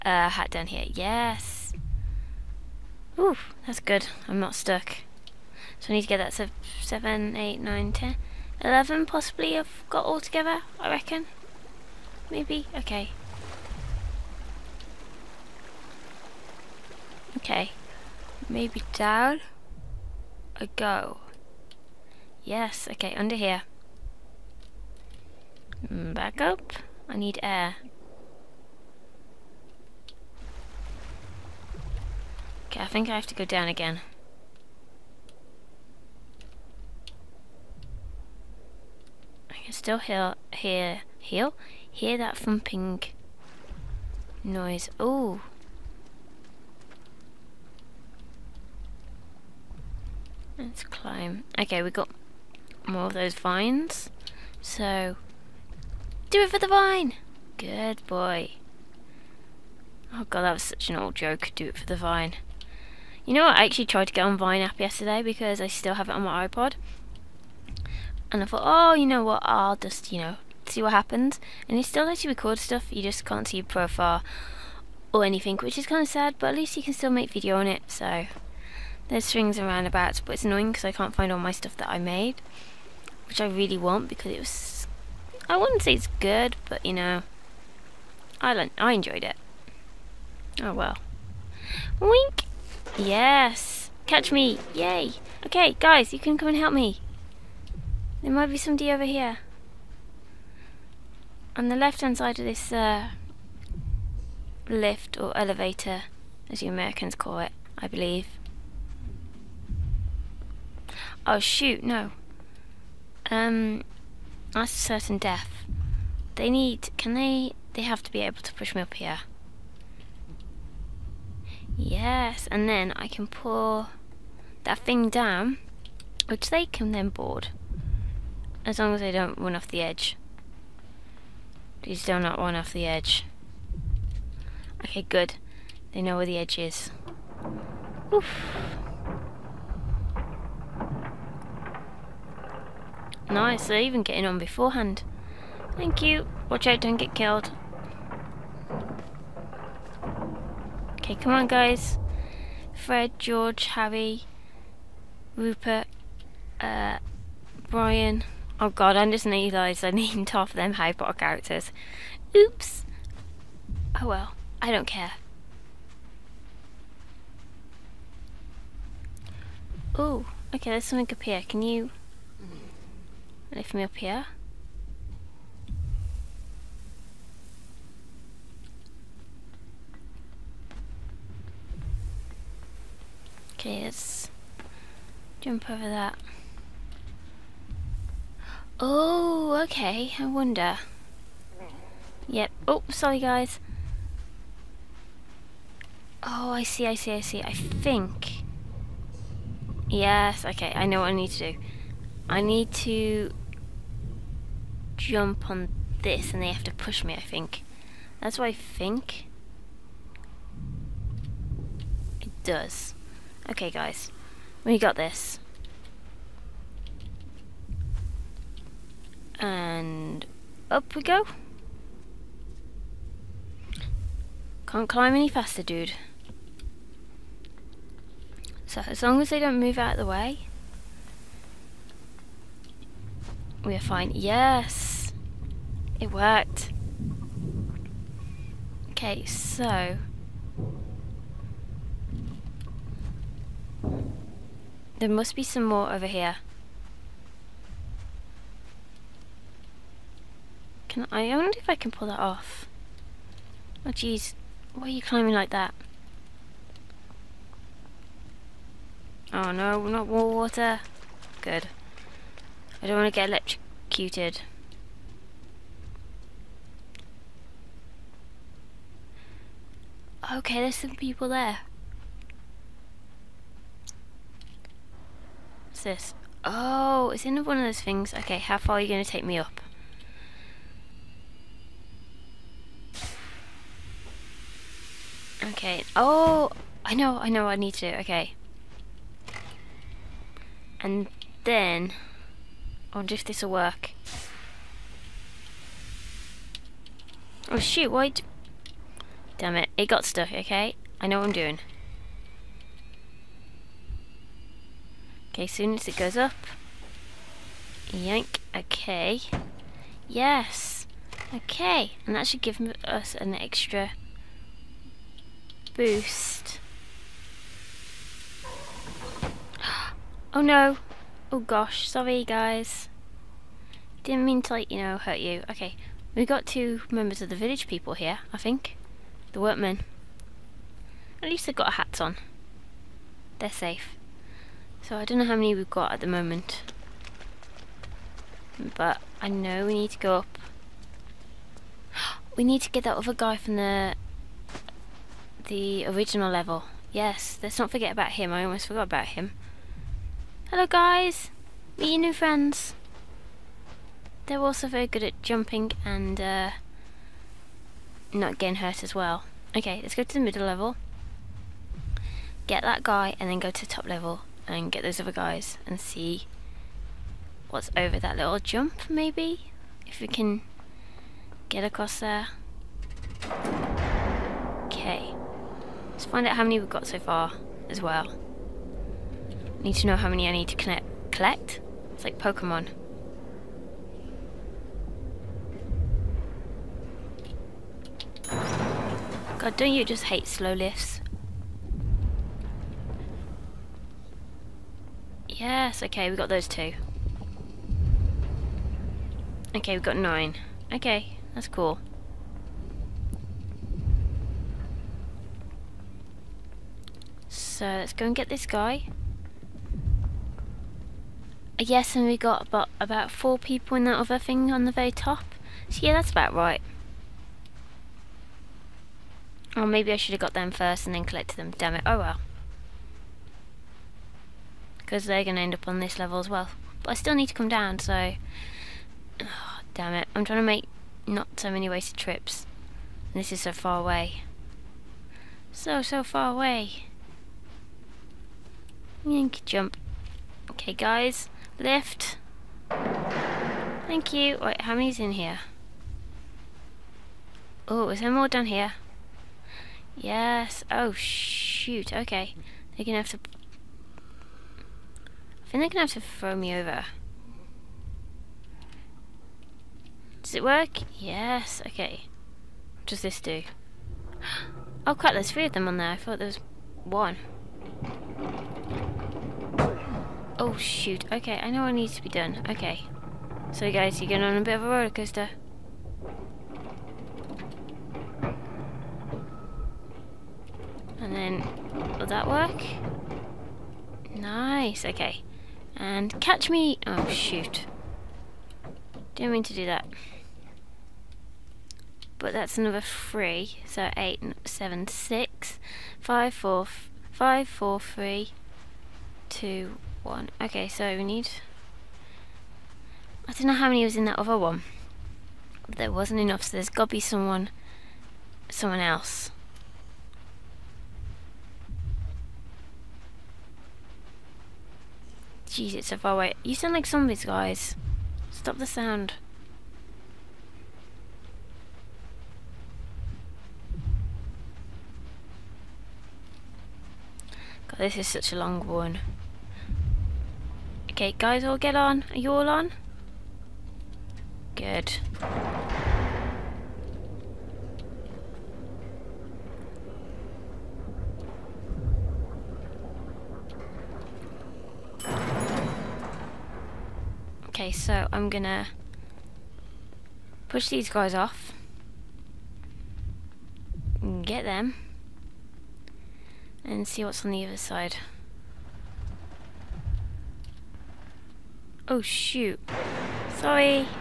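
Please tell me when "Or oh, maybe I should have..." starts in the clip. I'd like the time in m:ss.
6:59.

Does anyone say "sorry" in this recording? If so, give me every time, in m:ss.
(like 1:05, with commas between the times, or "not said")
3:12, 5:21, 9:23.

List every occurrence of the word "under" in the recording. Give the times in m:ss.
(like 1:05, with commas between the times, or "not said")
0:23.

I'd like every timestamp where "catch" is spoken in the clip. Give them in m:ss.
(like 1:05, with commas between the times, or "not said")
1:34, 8:06.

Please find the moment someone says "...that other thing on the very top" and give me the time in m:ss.
6:53.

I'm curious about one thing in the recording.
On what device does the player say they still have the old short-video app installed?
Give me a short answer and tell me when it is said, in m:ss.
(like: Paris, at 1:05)
iPod, at 1:06.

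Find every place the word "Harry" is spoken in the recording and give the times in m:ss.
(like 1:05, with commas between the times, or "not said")
2:33, 2:40.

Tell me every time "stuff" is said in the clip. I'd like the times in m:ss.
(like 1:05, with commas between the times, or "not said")
1:12, 1:21.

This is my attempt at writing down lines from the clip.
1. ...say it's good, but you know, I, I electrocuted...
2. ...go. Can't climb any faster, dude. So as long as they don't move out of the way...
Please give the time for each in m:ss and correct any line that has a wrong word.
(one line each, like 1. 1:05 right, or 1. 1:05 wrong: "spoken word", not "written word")
1. 1:25 wrong: "enjoyed", not "electrocuted"
2. 3:41 right.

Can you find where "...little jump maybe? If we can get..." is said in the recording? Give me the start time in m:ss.
6:08.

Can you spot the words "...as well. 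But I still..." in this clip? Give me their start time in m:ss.
7:06.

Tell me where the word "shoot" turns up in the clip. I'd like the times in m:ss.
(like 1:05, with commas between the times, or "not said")
1:51, 4:57, 7:30, 7:50, 8:07, 9:22.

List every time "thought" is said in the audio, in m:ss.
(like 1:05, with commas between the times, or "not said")
1:08, 7:45.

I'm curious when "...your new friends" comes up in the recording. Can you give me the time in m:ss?
5:51.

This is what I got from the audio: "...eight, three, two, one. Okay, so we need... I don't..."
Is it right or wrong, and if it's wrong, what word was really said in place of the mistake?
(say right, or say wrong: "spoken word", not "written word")
wrong: "four", not "eight".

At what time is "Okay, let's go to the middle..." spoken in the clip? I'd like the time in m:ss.
5:59.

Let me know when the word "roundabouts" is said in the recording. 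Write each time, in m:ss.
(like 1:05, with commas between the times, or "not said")
1:19.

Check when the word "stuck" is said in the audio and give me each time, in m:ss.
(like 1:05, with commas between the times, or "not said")
0:04, 5:00.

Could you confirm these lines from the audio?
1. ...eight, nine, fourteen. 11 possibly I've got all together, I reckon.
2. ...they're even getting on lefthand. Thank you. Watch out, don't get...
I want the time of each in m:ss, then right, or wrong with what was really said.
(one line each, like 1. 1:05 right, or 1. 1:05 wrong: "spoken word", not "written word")
1. 0:07 wrong: "ten", not "fourteen"
2. 2:23 wrong: "beforehand", not "lefthand".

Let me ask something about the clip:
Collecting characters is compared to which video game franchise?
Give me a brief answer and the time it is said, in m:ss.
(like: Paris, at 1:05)
Pokemon, at 6:22.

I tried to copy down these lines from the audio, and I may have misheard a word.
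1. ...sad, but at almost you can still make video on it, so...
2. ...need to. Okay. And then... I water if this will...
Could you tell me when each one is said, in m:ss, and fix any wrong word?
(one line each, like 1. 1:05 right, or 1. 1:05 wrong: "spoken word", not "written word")
1. 1:16 wrong: "least", not "almost"
2. 4:47 wrong: "wonder", not "water".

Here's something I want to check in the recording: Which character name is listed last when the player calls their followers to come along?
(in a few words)
Brian.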